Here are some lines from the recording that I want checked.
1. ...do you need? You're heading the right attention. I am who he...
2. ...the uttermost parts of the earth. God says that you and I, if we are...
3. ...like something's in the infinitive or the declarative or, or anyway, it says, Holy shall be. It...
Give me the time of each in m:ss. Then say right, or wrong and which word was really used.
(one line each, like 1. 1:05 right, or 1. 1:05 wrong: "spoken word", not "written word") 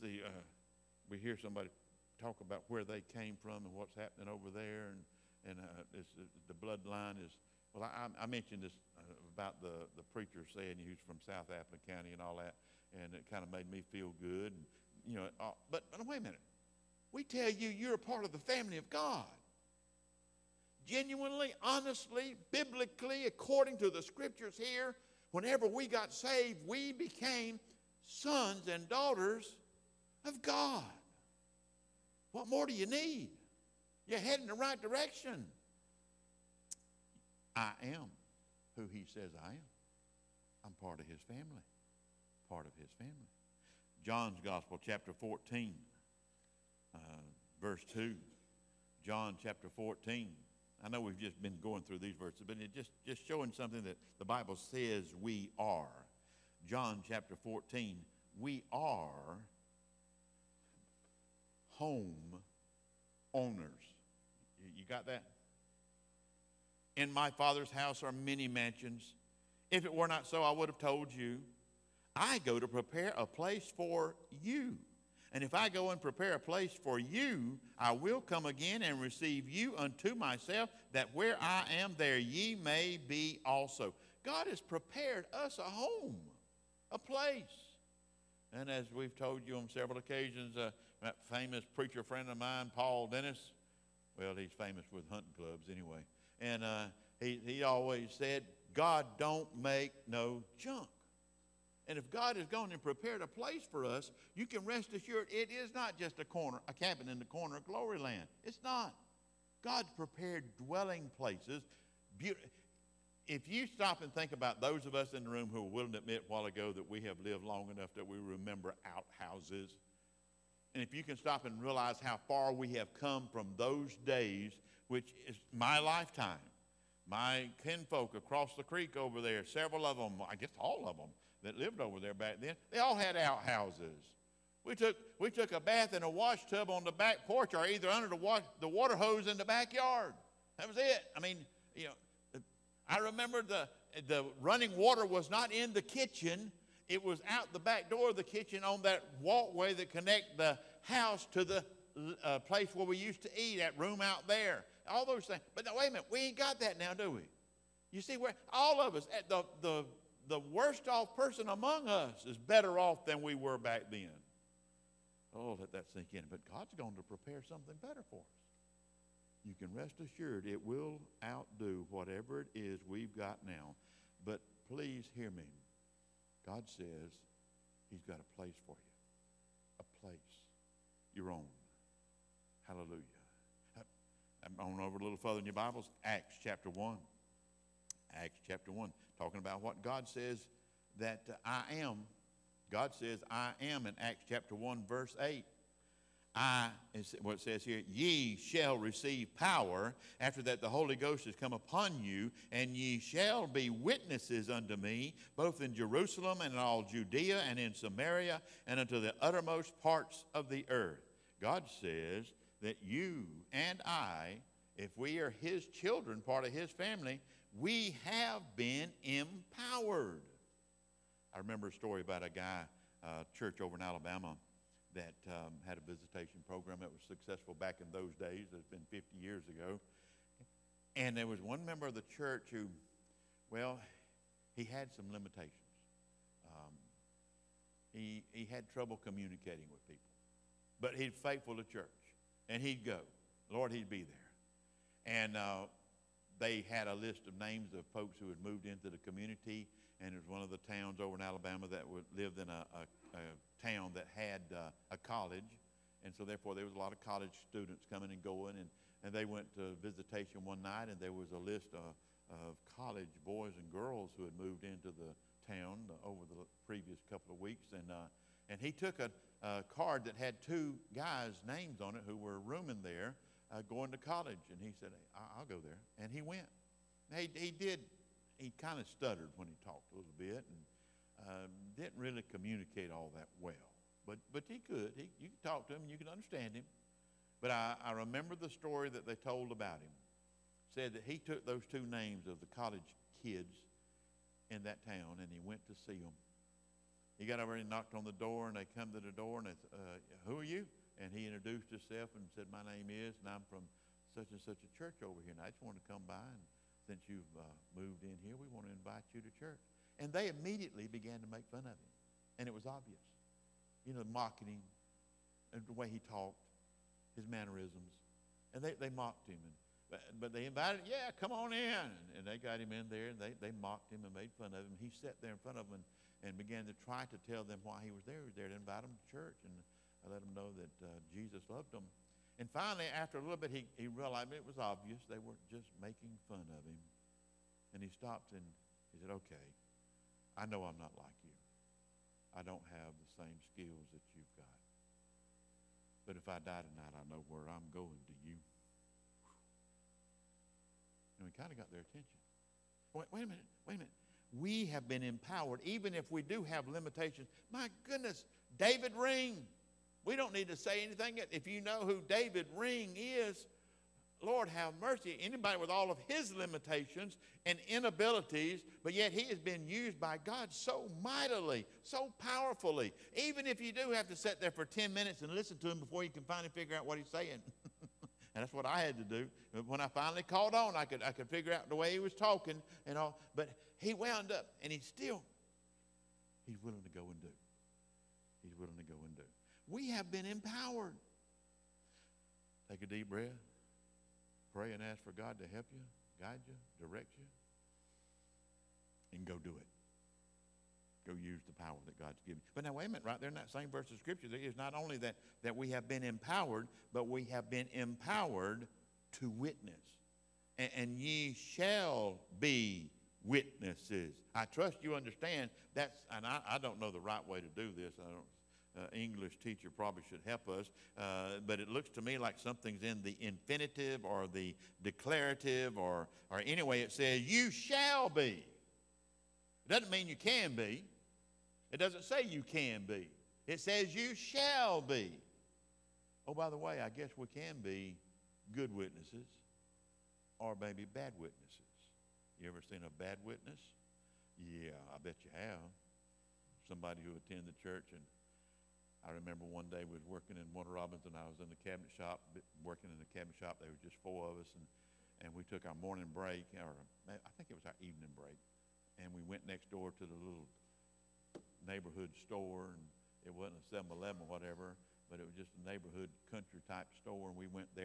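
1. 0:32 wrong: "direction", not "attention"
2. 3:28 right
3. 7:02 wrong: "You", not "Holy".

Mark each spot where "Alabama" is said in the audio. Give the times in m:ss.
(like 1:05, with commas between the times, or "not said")
3:43, 4:11.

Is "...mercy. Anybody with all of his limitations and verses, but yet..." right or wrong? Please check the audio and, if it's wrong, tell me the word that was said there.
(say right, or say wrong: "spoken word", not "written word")
wrong: "inabilities", not "verses".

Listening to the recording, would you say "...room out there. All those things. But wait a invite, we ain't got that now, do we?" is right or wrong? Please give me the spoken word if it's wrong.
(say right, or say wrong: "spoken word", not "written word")
wrong: "minute", not "invite".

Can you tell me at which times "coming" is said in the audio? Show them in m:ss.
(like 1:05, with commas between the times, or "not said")
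4:17.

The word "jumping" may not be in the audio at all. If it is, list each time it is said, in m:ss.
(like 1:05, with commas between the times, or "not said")
not said.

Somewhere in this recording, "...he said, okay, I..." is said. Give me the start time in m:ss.
5:38.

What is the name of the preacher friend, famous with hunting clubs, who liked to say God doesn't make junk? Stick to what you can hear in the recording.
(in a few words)
Paul Dennis.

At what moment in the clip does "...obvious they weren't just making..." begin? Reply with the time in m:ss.
5:34.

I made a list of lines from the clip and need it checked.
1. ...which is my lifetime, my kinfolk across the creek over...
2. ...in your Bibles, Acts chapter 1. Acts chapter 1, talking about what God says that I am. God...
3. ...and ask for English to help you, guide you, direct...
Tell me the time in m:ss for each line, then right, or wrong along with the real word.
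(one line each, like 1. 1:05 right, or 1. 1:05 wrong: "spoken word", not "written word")
1. 2:04 right
2. 3:05 right
3. 6:34 wrong: "God", not "English".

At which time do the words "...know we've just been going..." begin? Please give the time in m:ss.
0:50.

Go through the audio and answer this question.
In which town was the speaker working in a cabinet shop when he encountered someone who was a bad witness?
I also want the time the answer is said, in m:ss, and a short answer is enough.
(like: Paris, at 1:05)
Warner Robins, at 7:30.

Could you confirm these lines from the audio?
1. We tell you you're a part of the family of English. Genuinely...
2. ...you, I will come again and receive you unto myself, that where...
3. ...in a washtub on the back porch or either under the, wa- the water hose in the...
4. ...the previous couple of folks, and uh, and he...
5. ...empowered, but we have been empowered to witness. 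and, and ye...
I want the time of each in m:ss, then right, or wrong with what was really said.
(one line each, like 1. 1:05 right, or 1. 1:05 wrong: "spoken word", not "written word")
1. 0:17 wrong: "God", not "English"
2. 1:16 right
3. 2:15 right
4. 4:26 wrong: "weeks", not "folks"
5. 6:46 right.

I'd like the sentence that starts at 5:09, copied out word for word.
And they immediately began to make fun of him.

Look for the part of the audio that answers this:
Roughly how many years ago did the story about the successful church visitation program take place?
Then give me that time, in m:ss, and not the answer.
3:48.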